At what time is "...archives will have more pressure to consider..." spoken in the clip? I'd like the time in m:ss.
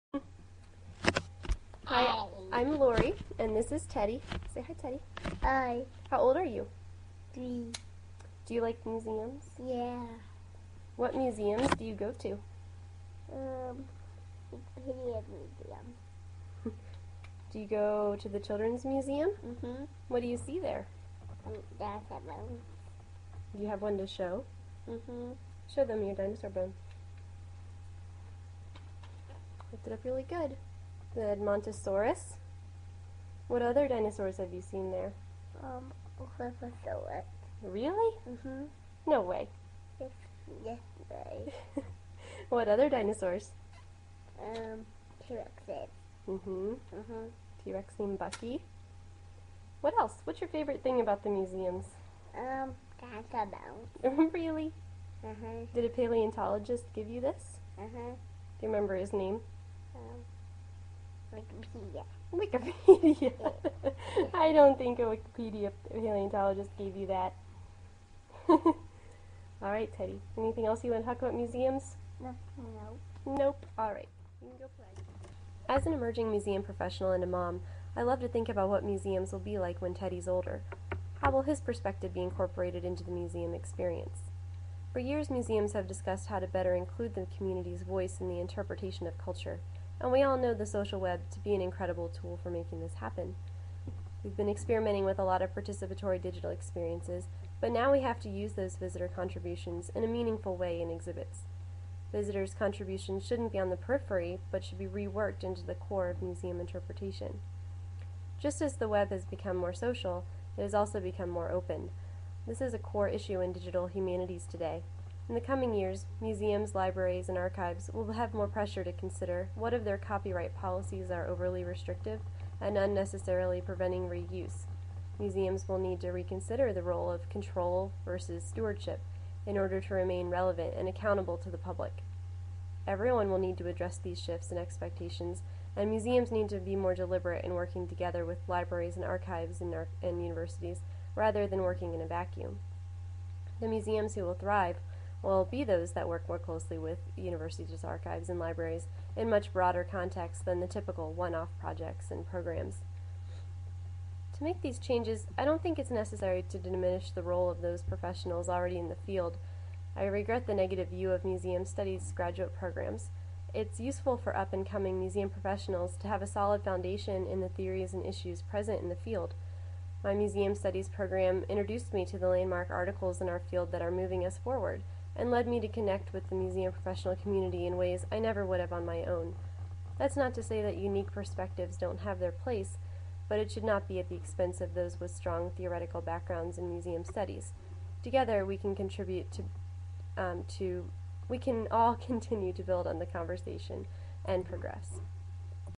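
1:57.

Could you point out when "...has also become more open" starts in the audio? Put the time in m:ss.
1:50.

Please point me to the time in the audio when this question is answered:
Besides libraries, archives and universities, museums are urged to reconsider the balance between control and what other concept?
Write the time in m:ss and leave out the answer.
2:08.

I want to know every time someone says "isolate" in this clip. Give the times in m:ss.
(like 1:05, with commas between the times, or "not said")
not said.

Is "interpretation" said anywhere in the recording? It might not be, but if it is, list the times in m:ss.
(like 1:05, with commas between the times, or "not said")
1:28, 1:46.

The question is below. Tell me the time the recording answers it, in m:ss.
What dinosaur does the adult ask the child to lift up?
0:31.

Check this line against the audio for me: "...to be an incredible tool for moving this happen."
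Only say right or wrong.
wrong.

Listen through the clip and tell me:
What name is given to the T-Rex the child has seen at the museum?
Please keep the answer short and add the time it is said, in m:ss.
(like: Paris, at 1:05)
Bucky, at 0:48.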